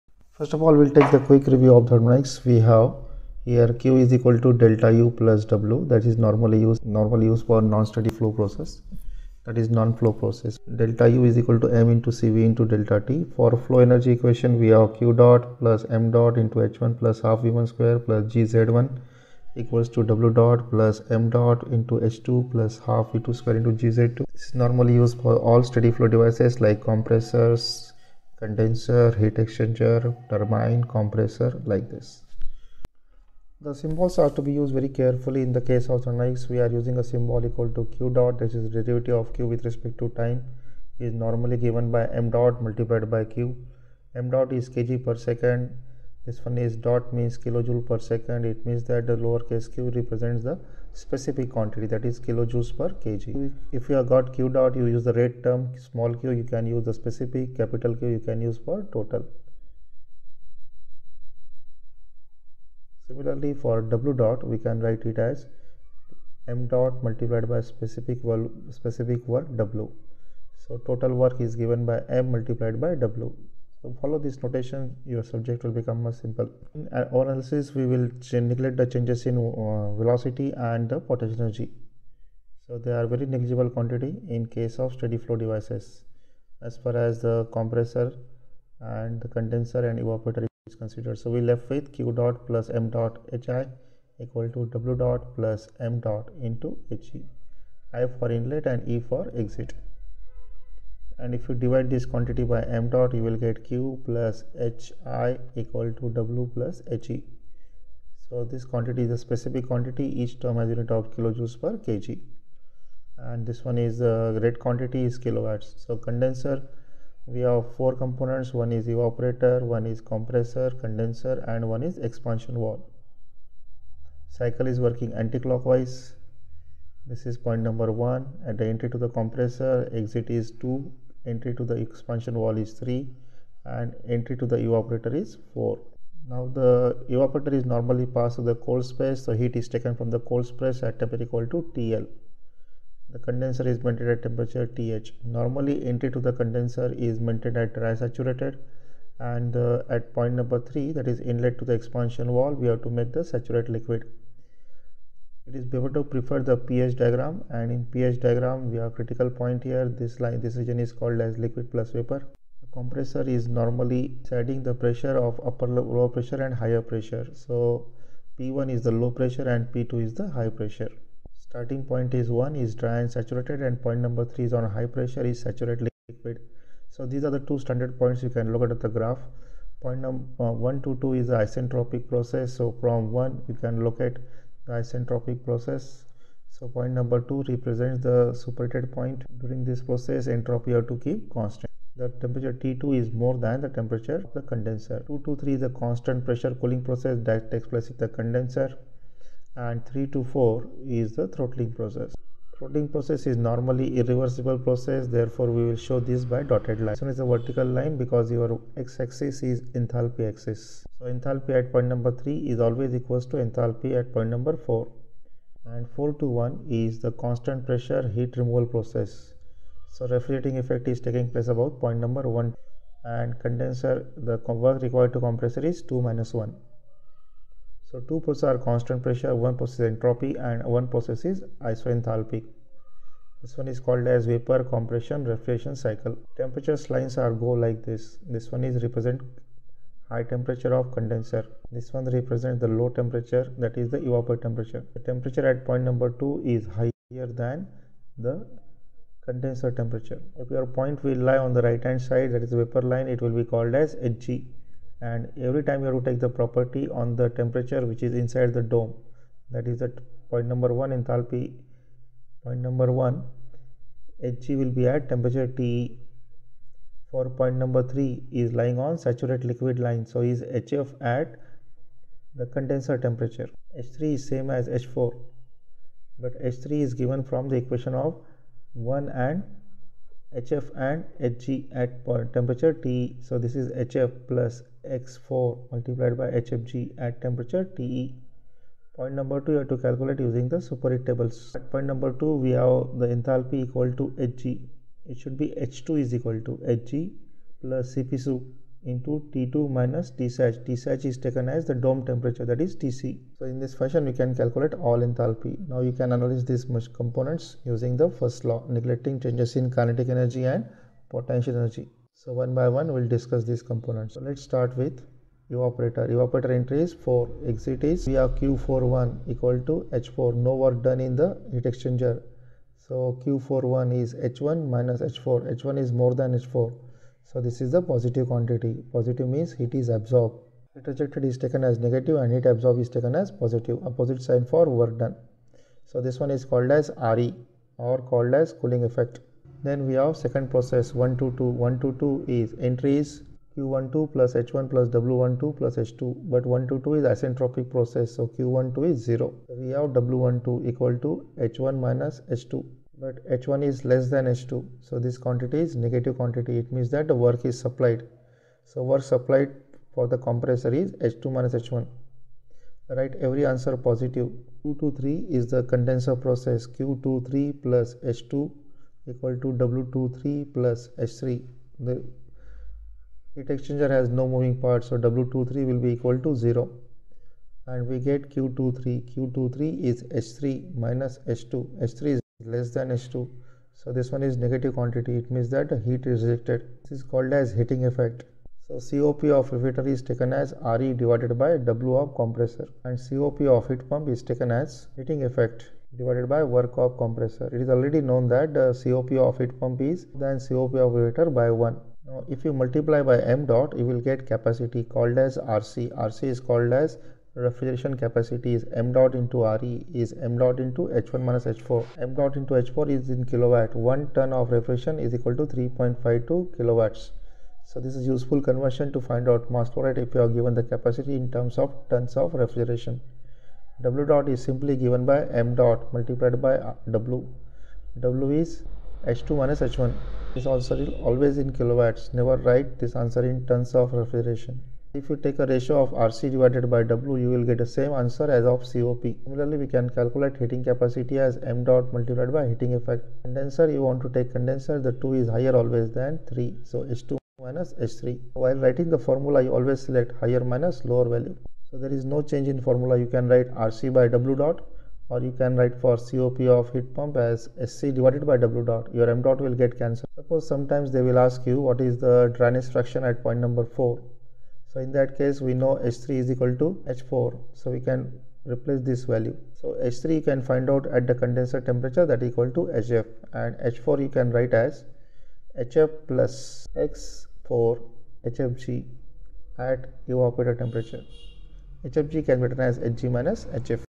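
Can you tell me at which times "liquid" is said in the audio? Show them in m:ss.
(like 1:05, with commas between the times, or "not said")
2:33, 2:41, 2:56, 4:29.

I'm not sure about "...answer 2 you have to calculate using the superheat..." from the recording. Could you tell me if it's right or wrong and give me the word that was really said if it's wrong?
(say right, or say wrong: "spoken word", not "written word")
wrong: "number", not "answer".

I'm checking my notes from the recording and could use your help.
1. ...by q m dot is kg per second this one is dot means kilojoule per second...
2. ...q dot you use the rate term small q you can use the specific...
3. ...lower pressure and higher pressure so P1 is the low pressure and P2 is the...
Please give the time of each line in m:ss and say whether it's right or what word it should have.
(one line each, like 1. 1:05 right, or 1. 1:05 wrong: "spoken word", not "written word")
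1. 0:43 right
2. 0:54 right
3. 2:45 right.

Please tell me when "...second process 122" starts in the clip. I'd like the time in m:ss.
5:40.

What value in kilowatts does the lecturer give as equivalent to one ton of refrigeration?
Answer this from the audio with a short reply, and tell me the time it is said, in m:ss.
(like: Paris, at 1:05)
3.52 kilowatts, at 6:55.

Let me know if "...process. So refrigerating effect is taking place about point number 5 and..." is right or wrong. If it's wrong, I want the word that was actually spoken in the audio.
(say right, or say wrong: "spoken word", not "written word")
wrong: "1", not "5".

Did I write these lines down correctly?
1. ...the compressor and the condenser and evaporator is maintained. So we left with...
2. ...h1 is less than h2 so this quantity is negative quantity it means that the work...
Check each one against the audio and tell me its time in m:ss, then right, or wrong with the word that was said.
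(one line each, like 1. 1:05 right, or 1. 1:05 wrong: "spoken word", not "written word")
1. 1:27 wrong: "considered", not "maintained"
2. 5:53 right.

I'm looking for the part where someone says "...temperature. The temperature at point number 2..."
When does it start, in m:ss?
4:04.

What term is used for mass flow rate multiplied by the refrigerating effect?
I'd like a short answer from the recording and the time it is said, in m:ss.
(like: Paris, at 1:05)
Refrigeration capacity, at 6:47.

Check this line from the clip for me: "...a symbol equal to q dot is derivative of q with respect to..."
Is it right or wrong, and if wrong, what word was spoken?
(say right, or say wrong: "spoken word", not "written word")
right.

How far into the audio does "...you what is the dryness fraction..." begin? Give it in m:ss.
7:41.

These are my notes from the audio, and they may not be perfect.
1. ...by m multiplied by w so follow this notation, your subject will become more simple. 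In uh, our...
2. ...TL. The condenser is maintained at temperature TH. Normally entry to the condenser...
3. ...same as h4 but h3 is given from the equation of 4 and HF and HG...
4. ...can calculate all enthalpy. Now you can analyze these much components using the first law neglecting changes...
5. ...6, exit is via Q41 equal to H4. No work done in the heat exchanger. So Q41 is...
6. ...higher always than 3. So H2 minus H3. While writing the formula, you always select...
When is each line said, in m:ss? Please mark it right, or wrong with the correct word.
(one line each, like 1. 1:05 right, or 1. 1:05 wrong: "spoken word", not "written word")
1. 1:11 right
2. 2:21 right
3. 4:34 wrong: "1", not "4"
4. 5:04 right
5. 5:16 wrong: "4", not "6"
6. 7:25 right.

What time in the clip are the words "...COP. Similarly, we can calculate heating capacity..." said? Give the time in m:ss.
7:18.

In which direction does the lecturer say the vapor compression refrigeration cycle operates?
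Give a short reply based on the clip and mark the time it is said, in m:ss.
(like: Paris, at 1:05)
Anticlockwise, at 2:05.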